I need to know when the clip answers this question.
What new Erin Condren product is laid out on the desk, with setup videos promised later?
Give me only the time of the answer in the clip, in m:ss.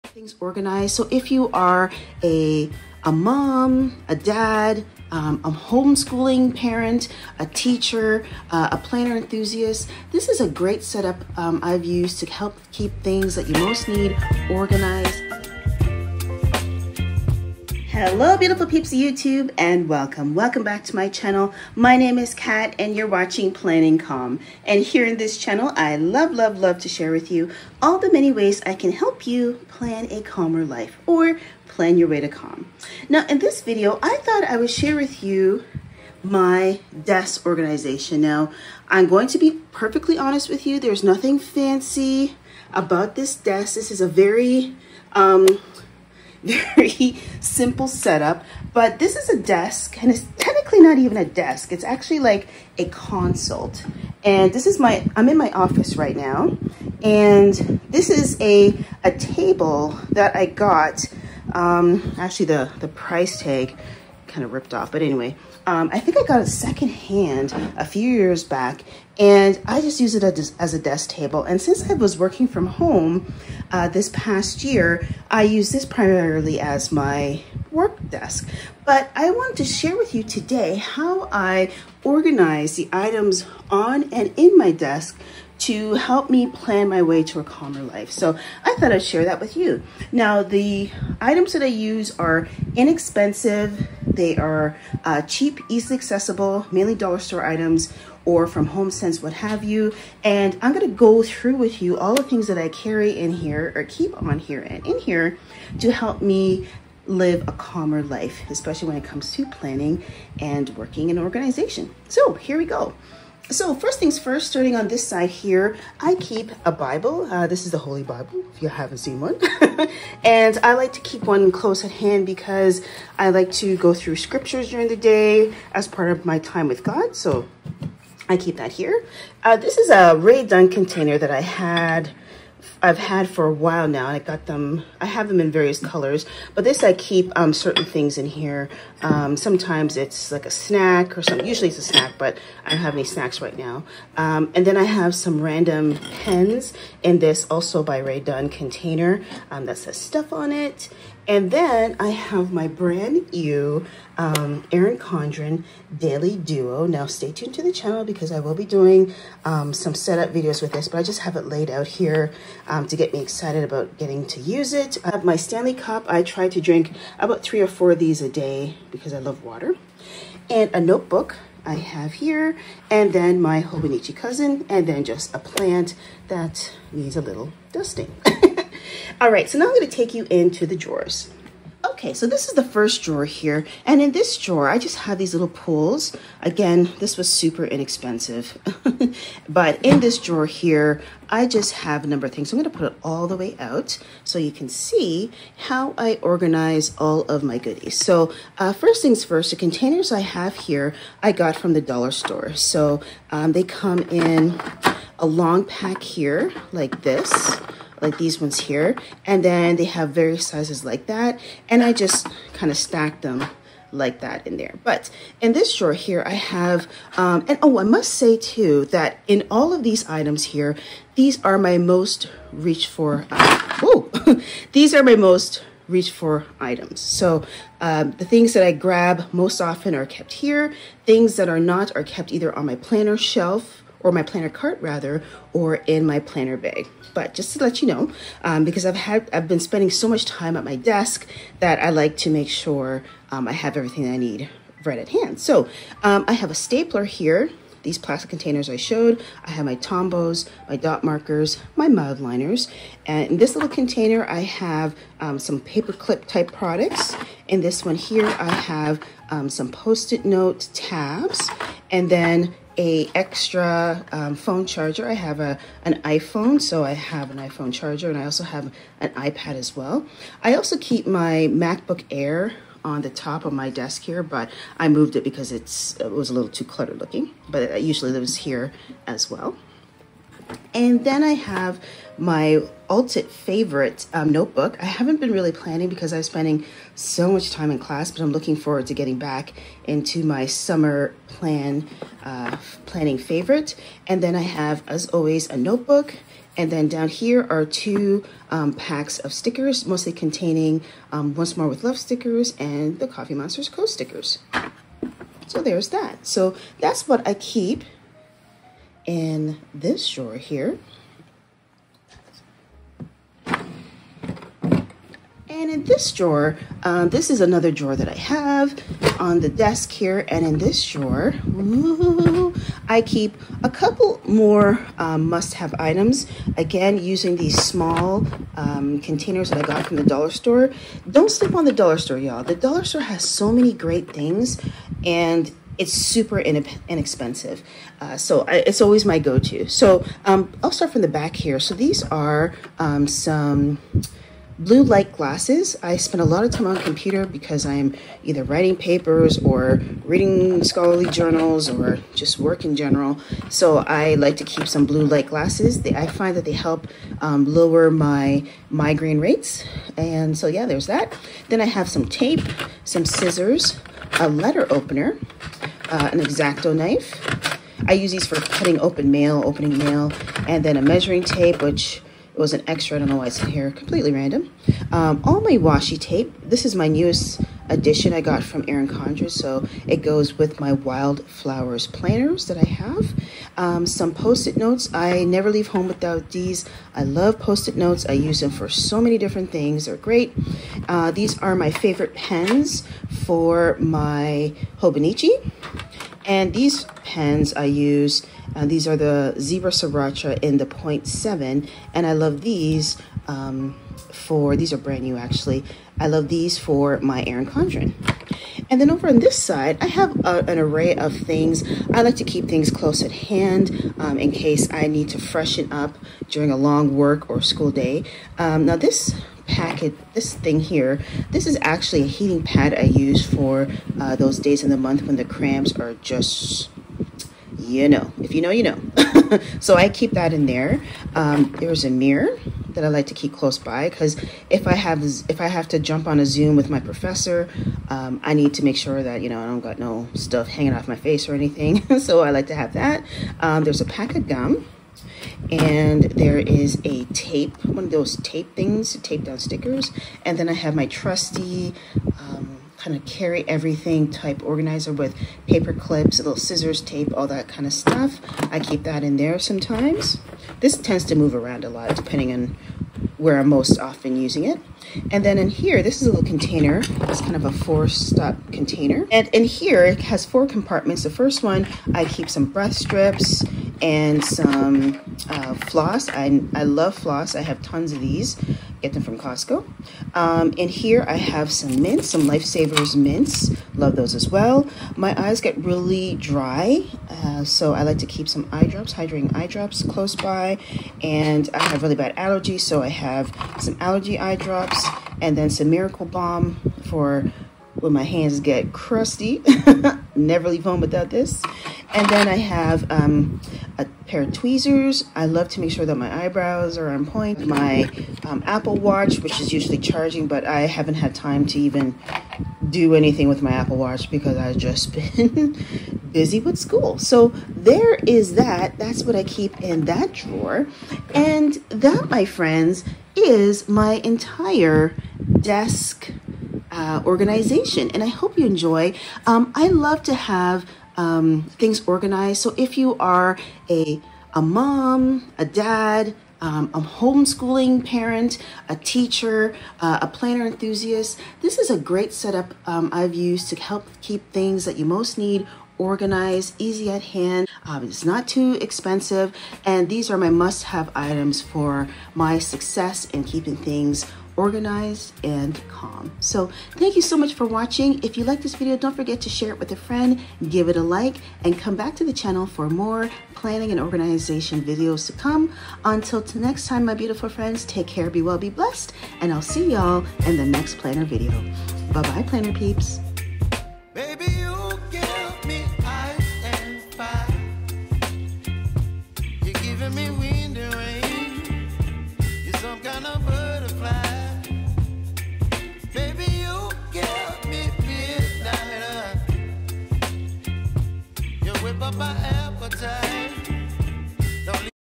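2:35.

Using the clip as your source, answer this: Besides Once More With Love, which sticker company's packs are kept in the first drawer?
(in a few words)
Coffee Monsters Co.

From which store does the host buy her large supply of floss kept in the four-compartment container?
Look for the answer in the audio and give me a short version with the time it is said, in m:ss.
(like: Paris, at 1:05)
Costco, at 7:59.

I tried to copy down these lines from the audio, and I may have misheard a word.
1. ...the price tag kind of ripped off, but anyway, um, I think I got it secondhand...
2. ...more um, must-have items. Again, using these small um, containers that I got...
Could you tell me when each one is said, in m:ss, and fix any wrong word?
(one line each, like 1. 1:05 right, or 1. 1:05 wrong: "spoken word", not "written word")
1. 1:02 right
2. 5:24 right.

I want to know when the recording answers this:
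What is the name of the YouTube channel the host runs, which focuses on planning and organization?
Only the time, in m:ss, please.
0:23.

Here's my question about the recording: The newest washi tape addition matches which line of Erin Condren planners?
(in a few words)
wildflowers.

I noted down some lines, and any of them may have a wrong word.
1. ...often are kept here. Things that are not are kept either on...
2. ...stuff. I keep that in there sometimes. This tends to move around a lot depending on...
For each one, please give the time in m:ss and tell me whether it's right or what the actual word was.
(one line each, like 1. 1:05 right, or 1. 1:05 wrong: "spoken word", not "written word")
1. 3:49 right
2. 7:37 right.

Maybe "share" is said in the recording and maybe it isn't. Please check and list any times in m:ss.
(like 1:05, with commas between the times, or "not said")
0:26, 0:34, 1:19, 1:29, 9:19.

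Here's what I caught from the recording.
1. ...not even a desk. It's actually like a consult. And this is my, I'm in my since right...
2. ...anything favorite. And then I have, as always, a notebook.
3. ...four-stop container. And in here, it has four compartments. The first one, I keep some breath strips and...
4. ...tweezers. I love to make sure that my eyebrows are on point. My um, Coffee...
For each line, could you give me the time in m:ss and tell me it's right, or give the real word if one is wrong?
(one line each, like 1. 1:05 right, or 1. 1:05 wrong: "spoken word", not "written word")
1. 0:50 wrong: "office", not "since"
2. 4:52 wrong: "planning", not "anything"
3. 7:47 right
4. 8:24 wrong: "Apple", not "Coffee".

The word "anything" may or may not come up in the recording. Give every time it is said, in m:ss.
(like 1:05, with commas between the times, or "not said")
7:21, 8:32.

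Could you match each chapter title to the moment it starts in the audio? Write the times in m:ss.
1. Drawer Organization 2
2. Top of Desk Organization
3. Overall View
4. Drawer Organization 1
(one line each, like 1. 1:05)
1. 5:15
2. 1:53
3. 8:43
4. 3:04.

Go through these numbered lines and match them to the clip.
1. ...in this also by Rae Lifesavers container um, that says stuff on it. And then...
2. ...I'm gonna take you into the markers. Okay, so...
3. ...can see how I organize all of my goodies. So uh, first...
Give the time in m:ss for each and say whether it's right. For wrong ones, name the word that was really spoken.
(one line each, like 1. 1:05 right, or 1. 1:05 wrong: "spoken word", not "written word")
1. 2:27 wrong: "Dunn", not "Lifesavers"
2. 2:59 wrong: "drawers", not "markers"
3. 3:14 right.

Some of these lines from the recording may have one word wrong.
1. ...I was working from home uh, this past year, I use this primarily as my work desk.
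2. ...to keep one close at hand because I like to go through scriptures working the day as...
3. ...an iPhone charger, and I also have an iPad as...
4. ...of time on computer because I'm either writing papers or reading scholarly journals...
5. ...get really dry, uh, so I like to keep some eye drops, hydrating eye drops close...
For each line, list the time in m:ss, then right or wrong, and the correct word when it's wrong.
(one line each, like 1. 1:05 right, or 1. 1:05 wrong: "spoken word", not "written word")
1. 1:11 right
2. 2:00 wrong: "during", not "working"
3. 4:27 right
4. 5:46 right
5. 8:05 right.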